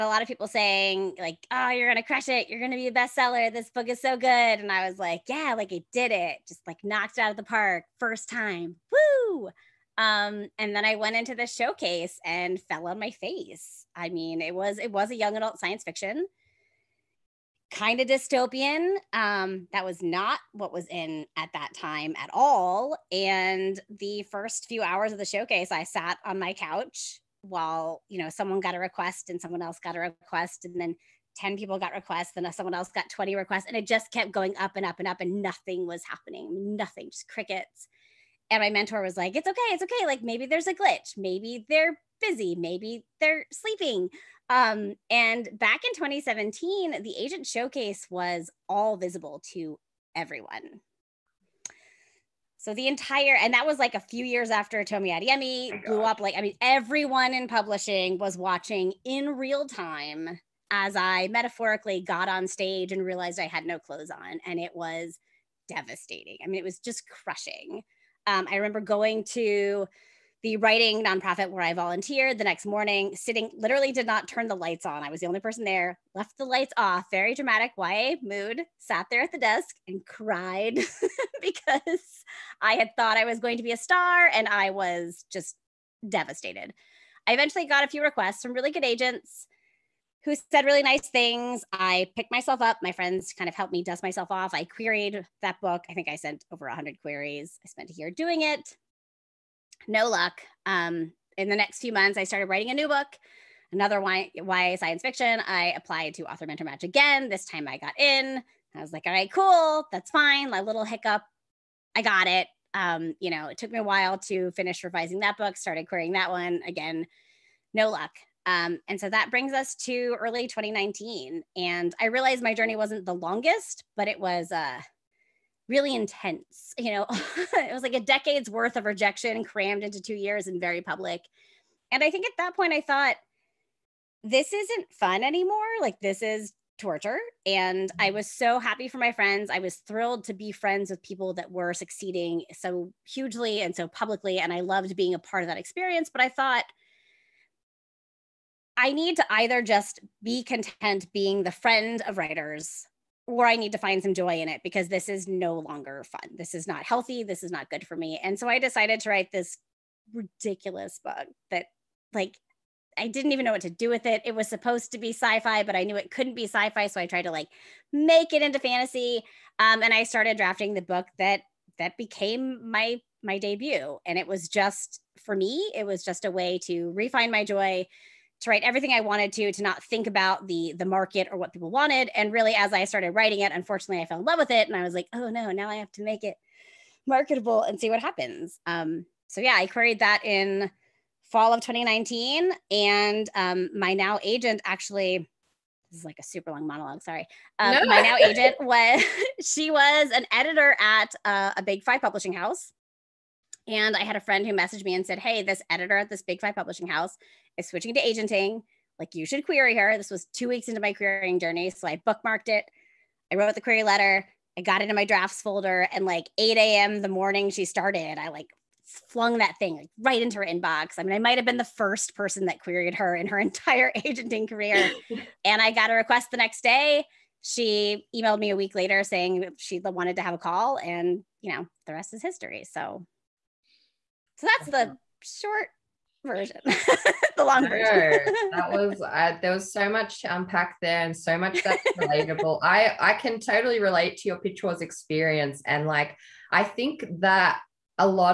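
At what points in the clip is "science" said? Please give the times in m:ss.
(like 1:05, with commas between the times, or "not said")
0:15, 1:44.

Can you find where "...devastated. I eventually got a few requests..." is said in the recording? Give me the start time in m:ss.
1:26.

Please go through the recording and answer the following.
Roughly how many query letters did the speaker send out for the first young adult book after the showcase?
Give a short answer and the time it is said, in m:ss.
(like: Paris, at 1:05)
over 100, at 1:36.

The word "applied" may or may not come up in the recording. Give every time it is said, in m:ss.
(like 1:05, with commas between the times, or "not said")
1:45.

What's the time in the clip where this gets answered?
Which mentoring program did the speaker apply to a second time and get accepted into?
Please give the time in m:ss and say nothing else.
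1:46.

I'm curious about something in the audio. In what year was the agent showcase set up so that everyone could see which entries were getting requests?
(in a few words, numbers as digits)
2017.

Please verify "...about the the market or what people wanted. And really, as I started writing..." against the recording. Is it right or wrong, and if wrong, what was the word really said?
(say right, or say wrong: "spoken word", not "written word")
right.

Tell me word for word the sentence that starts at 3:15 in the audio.
This is like a super long monologue.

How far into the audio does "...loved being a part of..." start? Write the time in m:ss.
2:24.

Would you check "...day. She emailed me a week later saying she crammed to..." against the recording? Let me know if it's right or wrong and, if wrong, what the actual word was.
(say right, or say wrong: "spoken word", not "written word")
wrong: "wanted", not "crammed".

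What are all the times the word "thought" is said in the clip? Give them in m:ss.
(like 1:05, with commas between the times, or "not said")
1:22, 2:12, 2:26.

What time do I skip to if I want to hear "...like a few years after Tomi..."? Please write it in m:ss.
0:53.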